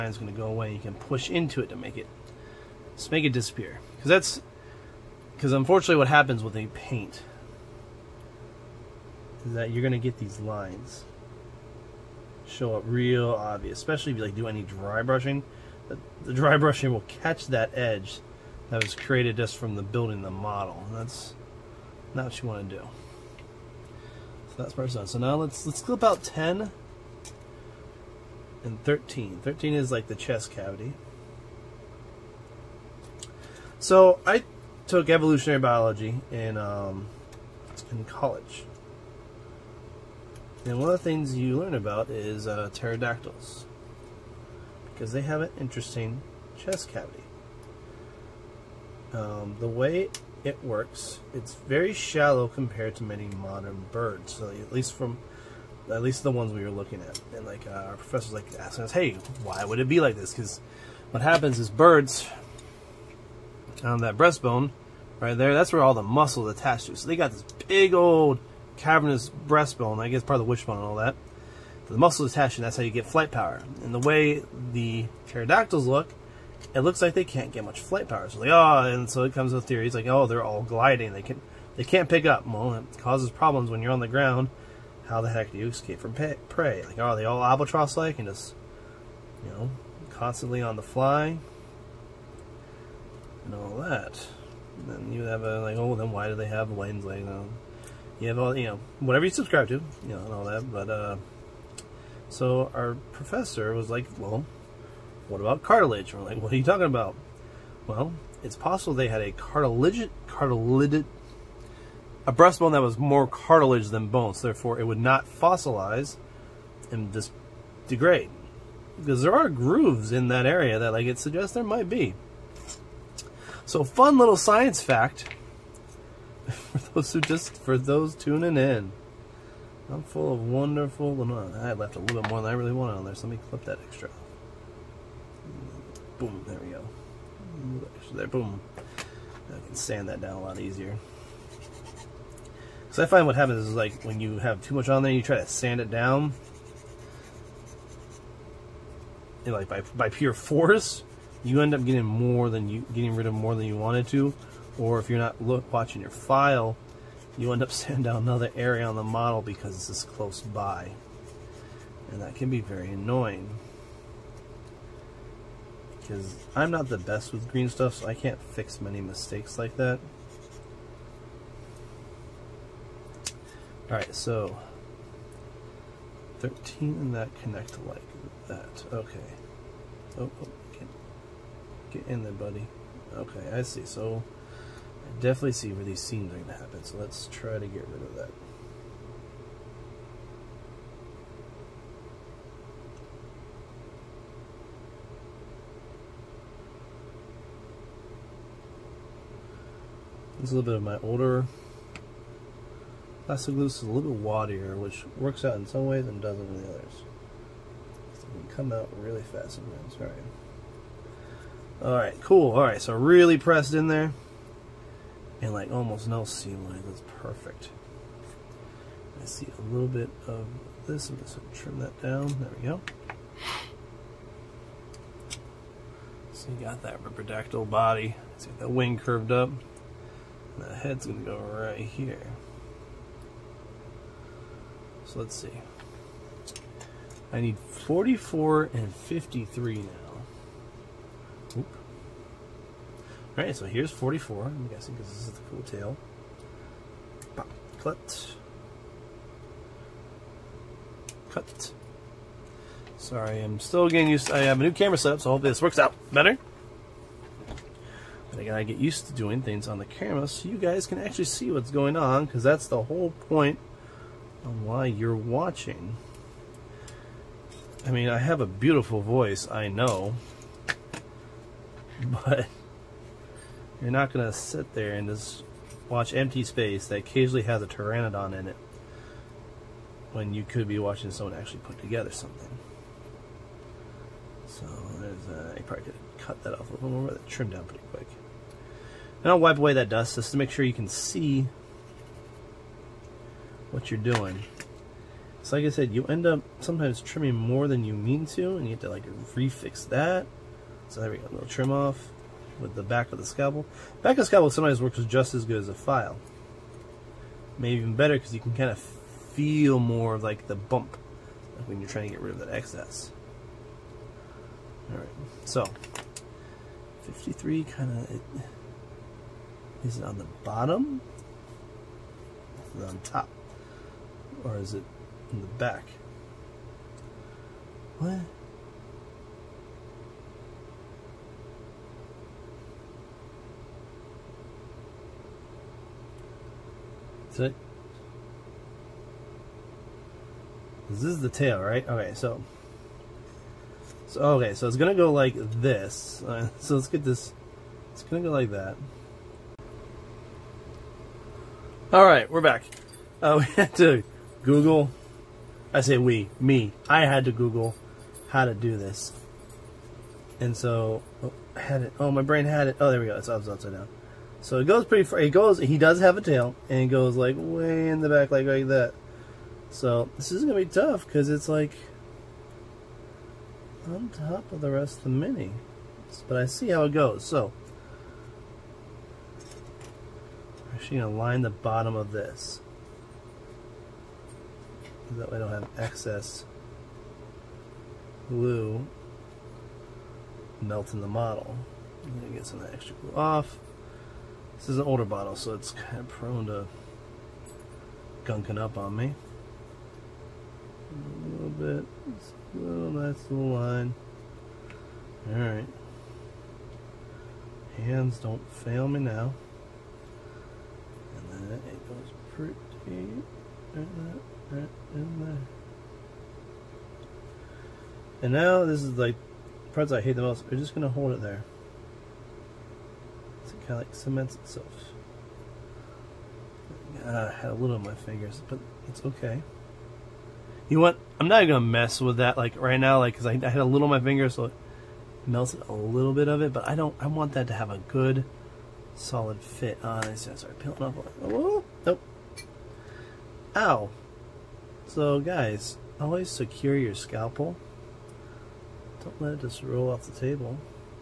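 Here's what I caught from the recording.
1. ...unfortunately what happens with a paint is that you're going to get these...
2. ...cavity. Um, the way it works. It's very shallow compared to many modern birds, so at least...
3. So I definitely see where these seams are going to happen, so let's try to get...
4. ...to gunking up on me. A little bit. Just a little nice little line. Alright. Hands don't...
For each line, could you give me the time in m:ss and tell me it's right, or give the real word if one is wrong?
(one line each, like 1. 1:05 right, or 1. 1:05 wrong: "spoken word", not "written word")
1. 0:05 right
2. 0:46 right
3. 3:03 right
4. 6:36 right.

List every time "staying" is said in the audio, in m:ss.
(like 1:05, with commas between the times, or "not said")
not said.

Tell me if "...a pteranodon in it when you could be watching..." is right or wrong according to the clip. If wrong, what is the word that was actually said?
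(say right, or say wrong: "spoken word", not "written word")
right.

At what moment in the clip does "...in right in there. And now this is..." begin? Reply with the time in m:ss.
6:52.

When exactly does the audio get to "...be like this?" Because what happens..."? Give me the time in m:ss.
0:59.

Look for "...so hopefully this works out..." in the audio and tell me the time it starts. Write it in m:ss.
4:15.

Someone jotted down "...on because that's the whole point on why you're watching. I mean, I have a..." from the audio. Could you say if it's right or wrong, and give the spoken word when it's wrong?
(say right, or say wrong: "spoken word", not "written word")
right.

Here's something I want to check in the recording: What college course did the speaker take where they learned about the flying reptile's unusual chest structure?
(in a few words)
evolutionary biology.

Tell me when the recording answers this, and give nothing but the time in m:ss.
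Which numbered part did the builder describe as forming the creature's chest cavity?
0:29.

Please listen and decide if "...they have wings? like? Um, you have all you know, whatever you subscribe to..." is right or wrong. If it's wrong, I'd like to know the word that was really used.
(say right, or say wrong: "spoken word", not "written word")
right.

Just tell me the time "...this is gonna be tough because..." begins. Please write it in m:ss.
6:10.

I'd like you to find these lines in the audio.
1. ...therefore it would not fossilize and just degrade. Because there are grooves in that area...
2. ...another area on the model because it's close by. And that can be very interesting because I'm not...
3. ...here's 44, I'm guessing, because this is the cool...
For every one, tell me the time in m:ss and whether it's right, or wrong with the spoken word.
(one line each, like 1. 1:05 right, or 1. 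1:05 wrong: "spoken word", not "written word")
1. 1:54 right
2. 2:38 wrong: "annoying", not "interesting"
3. 4:03 right.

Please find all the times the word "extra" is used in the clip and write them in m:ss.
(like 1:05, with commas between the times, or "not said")
2:13, 6:32.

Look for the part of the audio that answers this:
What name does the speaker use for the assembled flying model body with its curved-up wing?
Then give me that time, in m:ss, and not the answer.
3:47.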